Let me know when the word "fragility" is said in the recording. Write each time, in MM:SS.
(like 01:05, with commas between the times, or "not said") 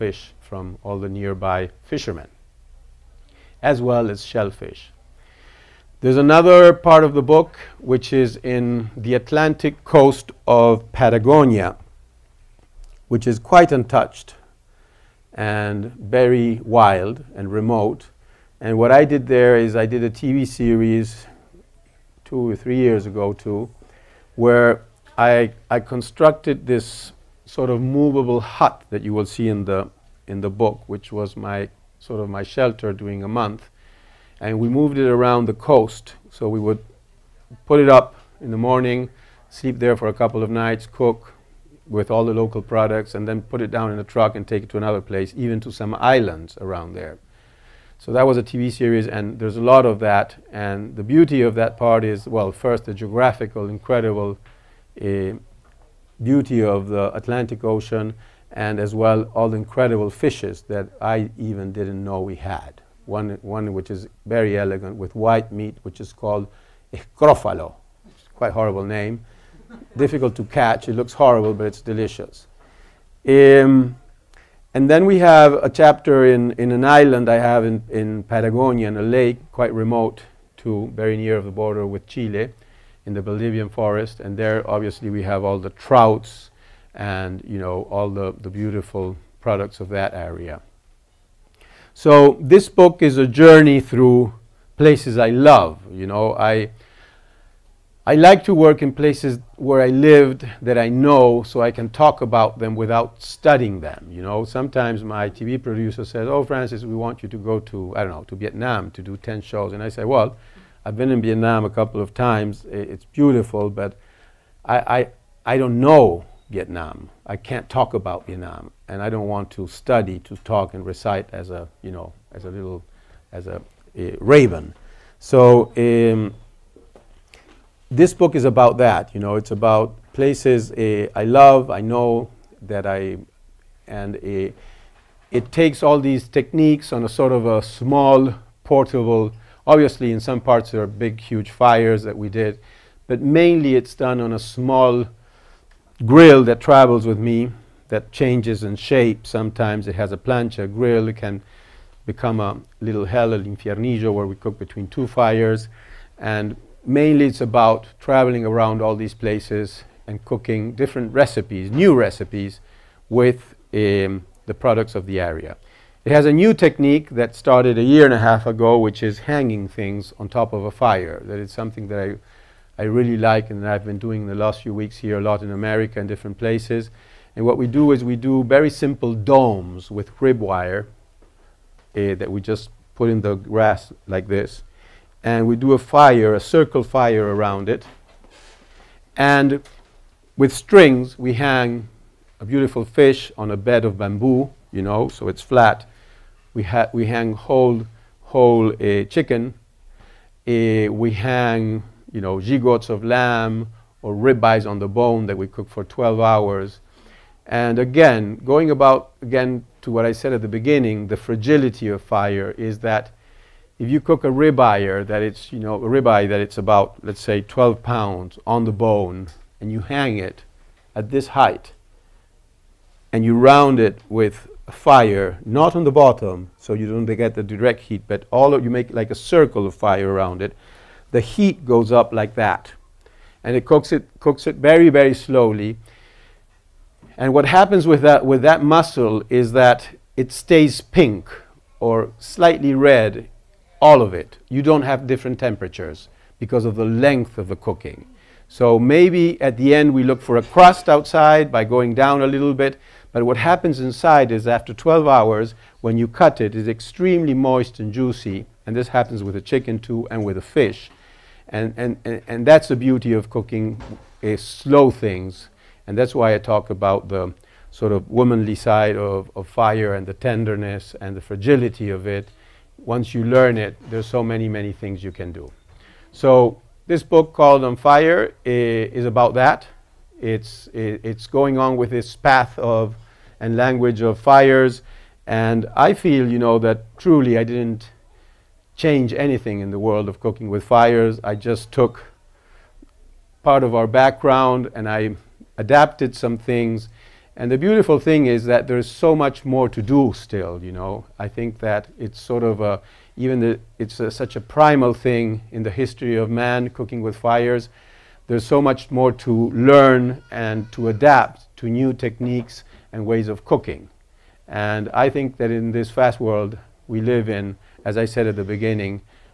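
03:31, 04:31.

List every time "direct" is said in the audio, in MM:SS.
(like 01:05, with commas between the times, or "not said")
03:47.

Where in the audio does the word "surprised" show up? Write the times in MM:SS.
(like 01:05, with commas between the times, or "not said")
not said.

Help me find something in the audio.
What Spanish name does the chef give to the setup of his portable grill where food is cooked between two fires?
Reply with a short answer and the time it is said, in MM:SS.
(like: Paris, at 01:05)
el infiernillo, at 02:33.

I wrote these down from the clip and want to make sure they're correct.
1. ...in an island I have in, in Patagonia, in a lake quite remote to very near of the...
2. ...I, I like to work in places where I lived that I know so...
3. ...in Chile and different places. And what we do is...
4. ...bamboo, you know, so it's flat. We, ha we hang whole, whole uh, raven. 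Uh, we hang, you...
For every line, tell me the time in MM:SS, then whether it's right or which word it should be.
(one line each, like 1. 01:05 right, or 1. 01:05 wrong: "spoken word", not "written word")
1. 01:16 right
2. 01:36 right
3. 02:55 wrong: "America", not "Chile"
4. 03:13 wrong: "chicken", not "raven".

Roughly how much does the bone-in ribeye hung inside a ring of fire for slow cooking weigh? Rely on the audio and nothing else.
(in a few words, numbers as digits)
12 pounds.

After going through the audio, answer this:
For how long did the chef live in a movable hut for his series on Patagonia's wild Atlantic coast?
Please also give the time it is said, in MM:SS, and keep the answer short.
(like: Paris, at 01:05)
a month, at 00:33.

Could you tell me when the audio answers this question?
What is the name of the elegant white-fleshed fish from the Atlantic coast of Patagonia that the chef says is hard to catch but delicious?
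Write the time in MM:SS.
01:06.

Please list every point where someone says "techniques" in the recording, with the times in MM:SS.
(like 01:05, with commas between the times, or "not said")
02:16, 02:46, 05:11.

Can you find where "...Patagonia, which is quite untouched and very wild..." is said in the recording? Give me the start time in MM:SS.
00:10.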